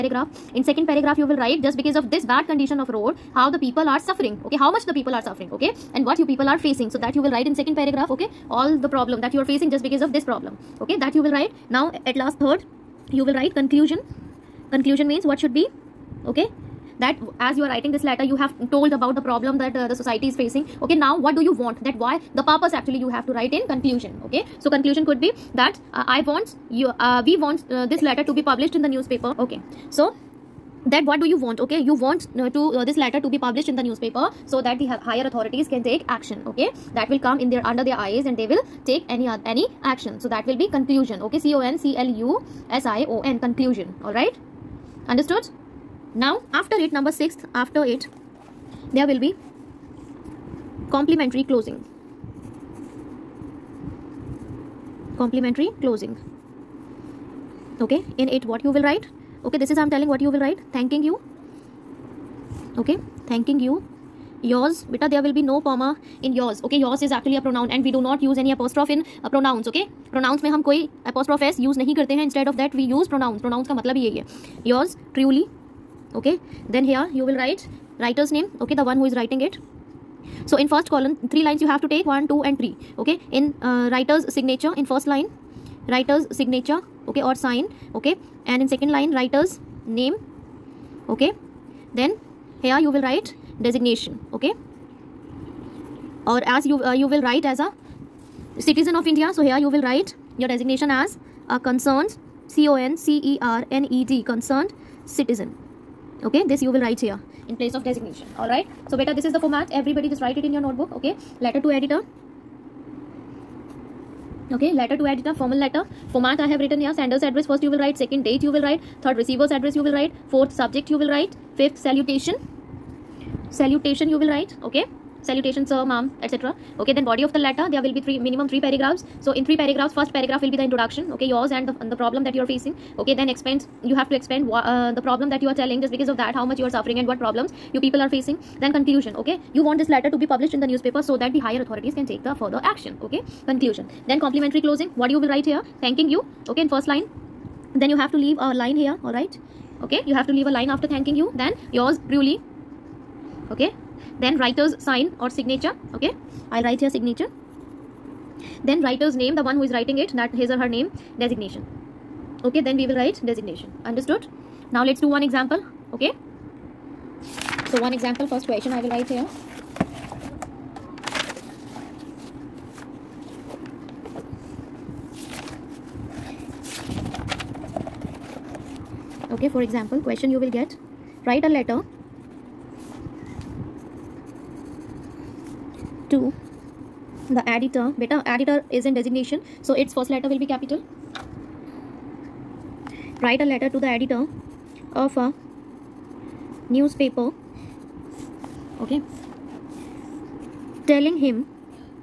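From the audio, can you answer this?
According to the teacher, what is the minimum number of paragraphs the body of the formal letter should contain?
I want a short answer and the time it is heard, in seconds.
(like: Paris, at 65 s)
3, at 128 s.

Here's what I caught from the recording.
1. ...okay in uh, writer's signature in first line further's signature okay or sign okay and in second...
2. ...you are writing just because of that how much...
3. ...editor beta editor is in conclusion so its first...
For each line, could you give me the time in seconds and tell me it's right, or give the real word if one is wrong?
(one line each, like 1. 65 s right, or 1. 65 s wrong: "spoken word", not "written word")
1. 83 s wrong: "writer", not "further"
2. 135 s wrong: "telling", not "writing"
3. 187 s wrong: "designation", not "conclusion".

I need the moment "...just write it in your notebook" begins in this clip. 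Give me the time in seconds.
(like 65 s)
110 s.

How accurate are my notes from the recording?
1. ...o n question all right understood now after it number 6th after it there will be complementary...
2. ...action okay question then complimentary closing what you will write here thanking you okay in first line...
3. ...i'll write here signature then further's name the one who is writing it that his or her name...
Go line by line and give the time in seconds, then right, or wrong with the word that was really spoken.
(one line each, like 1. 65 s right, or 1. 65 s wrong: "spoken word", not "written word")
1. 43 s wrong: "conclusion", not "question"
2. 142 s wrong: "conclusion", not "question"
3. 156 s wrong: "writer", not "further".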